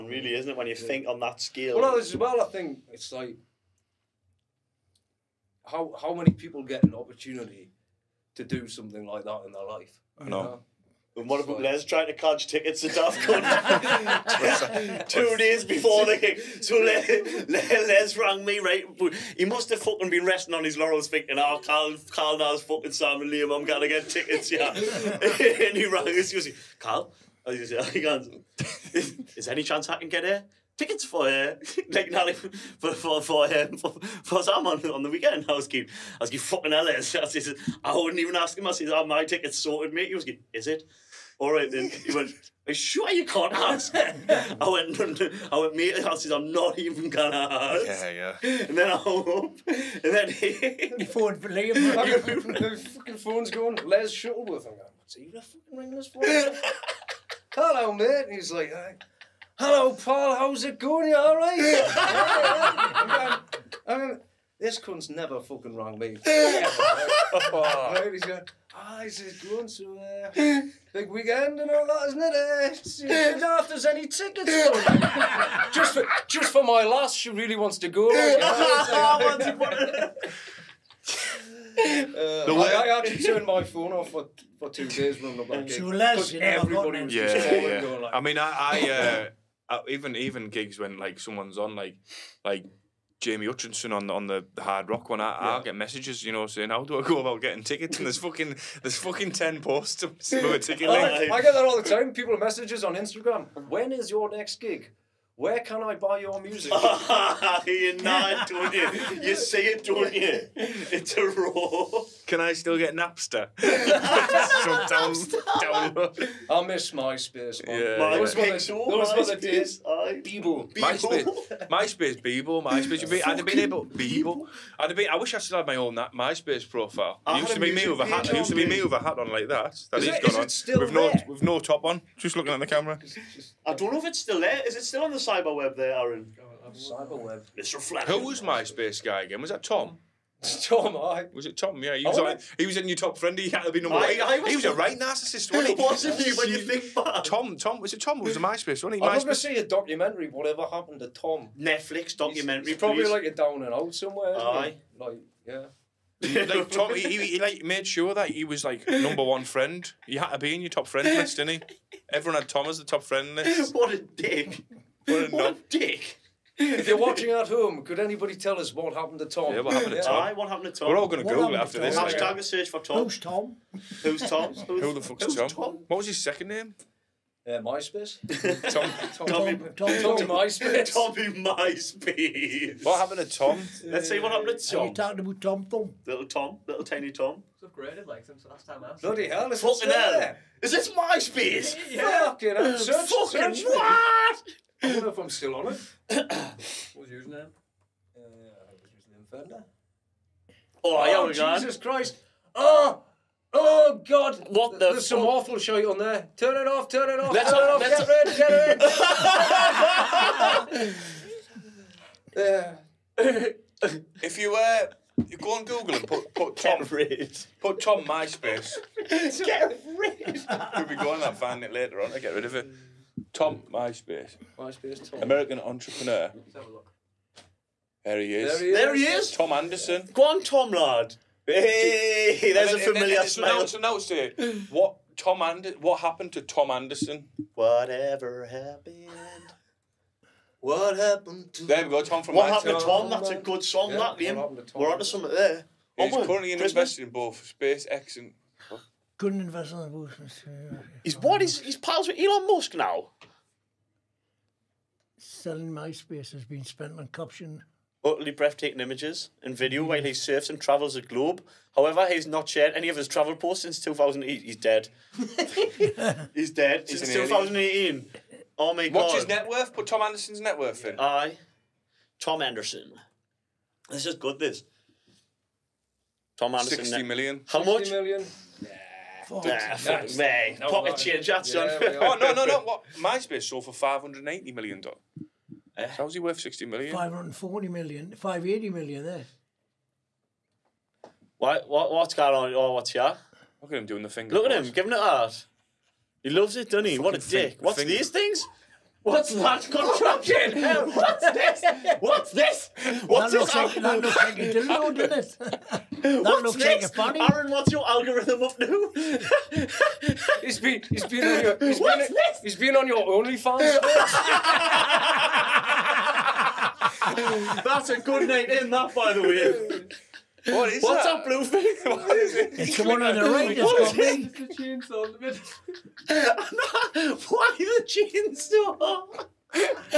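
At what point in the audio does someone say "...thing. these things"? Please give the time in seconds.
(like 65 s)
297 s.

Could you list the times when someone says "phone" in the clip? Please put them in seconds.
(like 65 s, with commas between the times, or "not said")
53 s, 83 s.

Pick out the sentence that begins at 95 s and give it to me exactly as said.
I'll get messages, you know, saying how do I go about getting tickets?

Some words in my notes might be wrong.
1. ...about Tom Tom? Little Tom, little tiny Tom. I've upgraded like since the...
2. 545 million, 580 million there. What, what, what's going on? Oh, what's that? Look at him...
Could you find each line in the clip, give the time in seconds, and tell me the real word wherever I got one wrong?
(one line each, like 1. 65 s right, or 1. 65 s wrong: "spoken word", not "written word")
1. 185 s right
2. 286 s wrong: "540", not "545".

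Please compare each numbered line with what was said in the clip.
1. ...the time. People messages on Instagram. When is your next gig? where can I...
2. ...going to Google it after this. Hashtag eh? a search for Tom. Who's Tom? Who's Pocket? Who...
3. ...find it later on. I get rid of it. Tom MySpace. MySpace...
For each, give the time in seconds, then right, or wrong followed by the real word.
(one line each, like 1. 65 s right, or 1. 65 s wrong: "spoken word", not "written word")
1. 101 s right
2. 171 s wrong: "Tom", not "Pocket"
3. 221 s right.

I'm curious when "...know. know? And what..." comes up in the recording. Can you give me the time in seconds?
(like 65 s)
10 s.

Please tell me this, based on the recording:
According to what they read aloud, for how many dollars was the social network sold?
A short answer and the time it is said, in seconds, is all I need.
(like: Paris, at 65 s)
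$580 million, at 283 s.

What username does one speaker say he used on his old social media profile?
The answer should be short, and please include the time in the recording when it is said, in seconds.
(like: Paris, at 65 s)
Inferno, at 199 s.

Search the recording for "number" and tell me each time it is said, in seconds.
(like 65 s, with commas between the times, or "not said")
143 s, 158 s.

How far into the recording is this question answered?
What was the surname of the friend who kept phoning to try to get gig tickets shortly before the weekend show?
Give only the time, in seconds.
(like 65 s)
53 s.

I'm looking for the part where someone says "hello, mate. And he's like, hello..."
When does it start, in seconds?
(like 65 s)
57 s.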